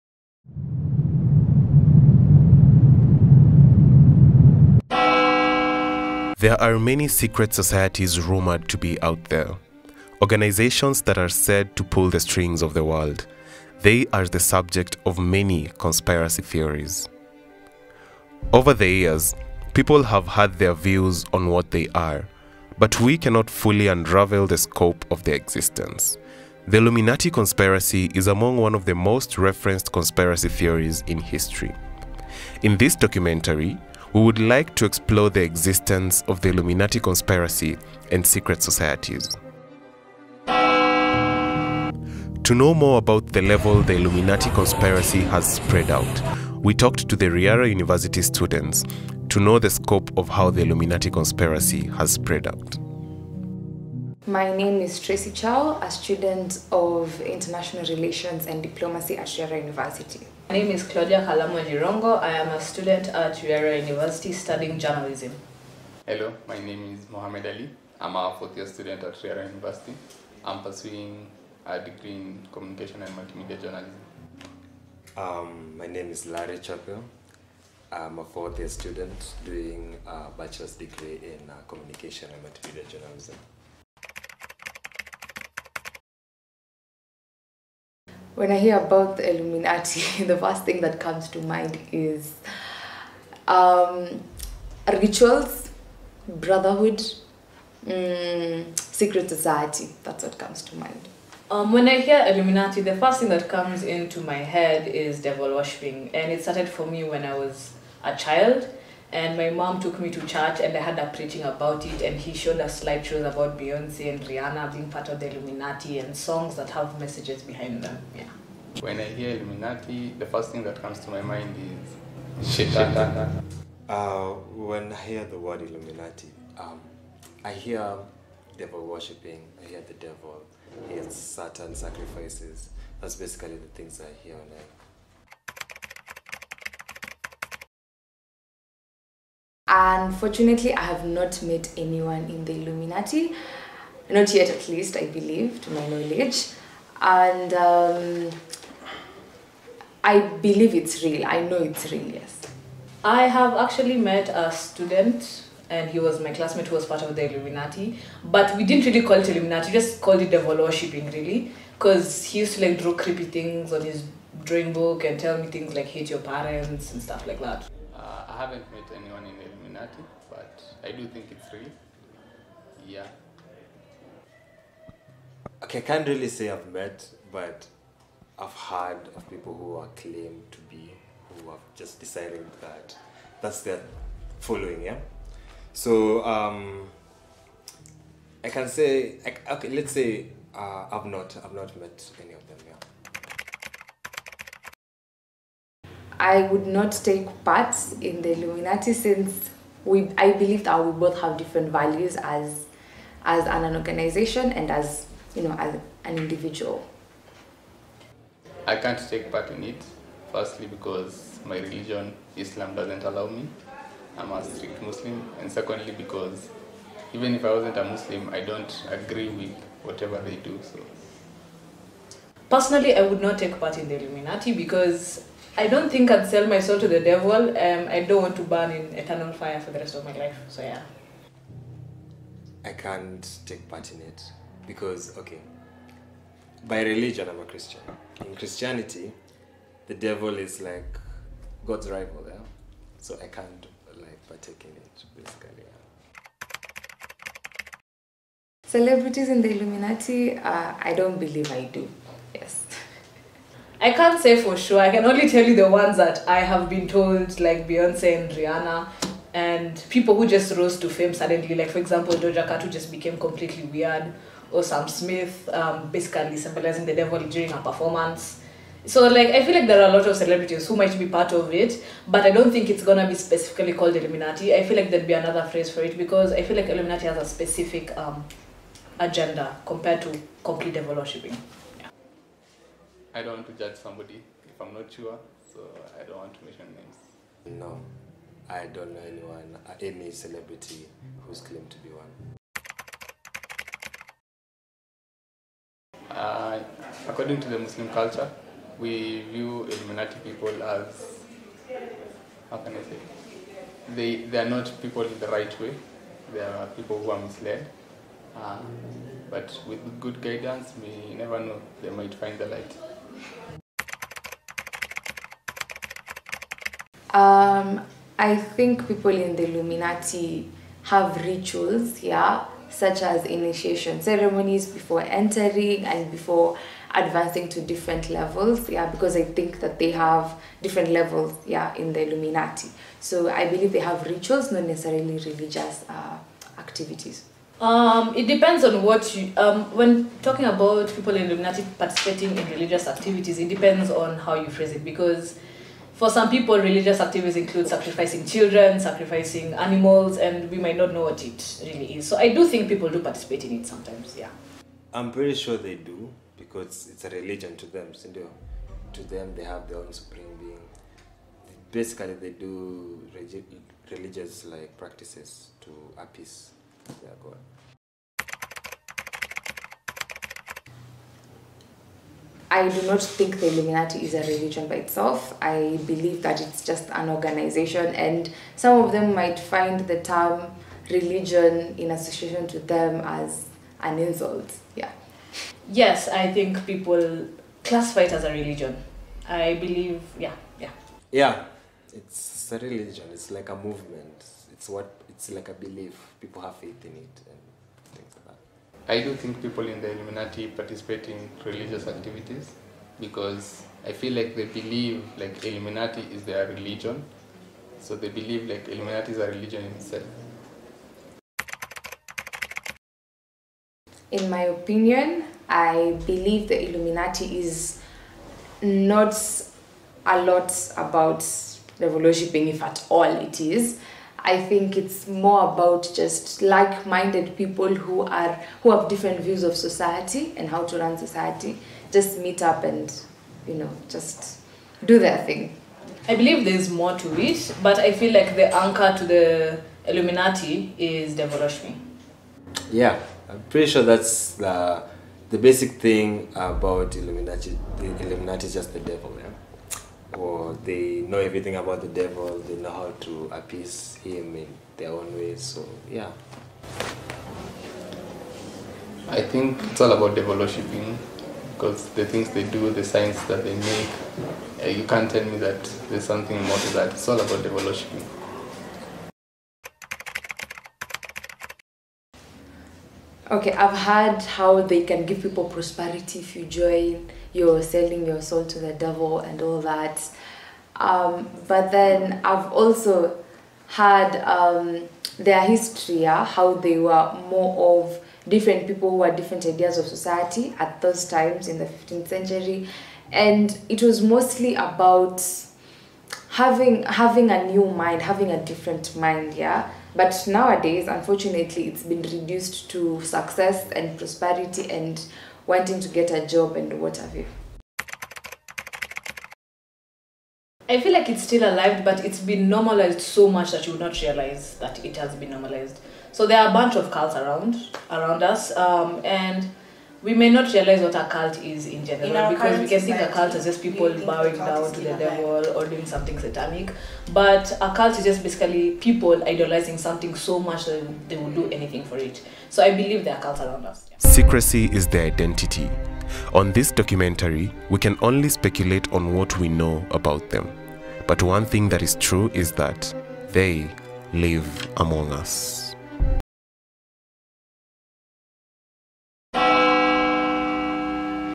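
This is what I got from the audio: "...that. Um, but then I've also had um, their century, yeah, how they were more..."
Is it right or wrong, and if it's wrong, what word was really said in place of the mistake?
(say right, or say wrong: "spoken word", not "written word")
wrong: "history", not "century".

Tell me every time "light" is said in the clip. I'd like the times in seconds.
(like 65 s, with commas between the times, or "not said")
312 s.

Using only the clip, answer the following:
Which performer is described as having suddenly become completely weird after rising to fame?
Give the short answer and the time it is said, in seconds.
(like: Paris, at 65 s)
Doja Cat, at 262 s.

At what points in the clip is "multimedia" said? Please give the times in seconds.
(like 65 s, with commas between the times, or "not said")
73 s, 82 s.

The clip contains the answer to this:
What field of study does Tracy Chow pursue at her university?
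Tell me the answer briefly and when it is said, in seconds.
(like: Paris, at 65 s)
International Relations and Diplomacy, at 57 s.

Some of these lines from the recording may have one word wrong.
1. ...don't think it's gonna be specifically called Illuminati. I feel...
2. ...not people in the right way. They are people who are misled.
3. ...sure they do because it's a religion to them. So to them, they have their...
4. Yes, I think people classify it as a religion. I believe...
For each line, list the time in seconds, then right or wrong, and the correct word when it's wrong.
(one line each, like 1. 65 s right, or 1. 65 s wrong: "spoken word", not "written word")
1. 272 s right
2. 304 s right
3. 355 s right
4. 385 s right.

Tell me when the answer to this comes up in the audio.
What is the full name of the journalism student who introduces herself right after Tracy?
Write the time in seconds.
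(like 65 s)
60 s.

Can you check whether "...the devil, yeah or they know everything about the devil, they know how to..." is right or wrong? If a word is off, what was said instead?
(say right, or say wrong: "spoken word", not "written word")
right.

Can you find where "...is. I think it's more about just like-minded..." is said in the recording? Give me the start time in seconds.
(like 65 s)
423 s.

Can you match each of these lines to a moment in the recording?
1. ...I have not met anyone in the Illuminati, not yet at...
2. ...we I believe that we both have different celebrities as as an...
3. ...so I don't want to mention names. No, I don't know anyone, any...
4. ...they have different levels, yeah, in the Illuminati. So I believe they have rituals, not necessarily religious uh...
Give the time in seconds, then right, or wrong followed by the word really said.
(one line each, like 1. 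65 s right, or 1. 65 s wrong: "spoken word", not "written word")
1. 140 s right
2. 199 s wrong: "values", not "celebrities"
3. 285 s right
4. 329 s right.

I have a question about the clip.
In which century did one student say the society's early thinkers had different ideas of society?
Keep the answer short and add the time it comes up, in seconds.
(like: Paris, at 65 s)
15th century, at 491 s.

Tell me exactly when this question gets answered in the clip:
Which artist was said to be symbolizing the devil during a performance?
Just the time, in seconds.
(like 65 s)
264 s.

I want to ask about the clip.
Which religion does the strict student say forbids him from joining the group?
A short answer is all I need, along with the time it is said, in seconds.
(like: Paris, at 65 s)
Islam, at 212 s.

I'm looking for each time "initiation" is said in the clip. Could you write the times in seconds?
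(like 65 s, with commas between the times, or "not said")
323 s.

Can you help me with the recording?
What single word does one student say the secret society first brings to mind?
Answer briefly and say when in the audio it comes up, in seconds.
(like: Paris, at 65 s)
Shaitan, at 122 s.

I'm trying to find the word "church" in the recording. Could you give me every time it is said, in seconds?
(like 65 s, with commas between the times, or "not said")
110 s.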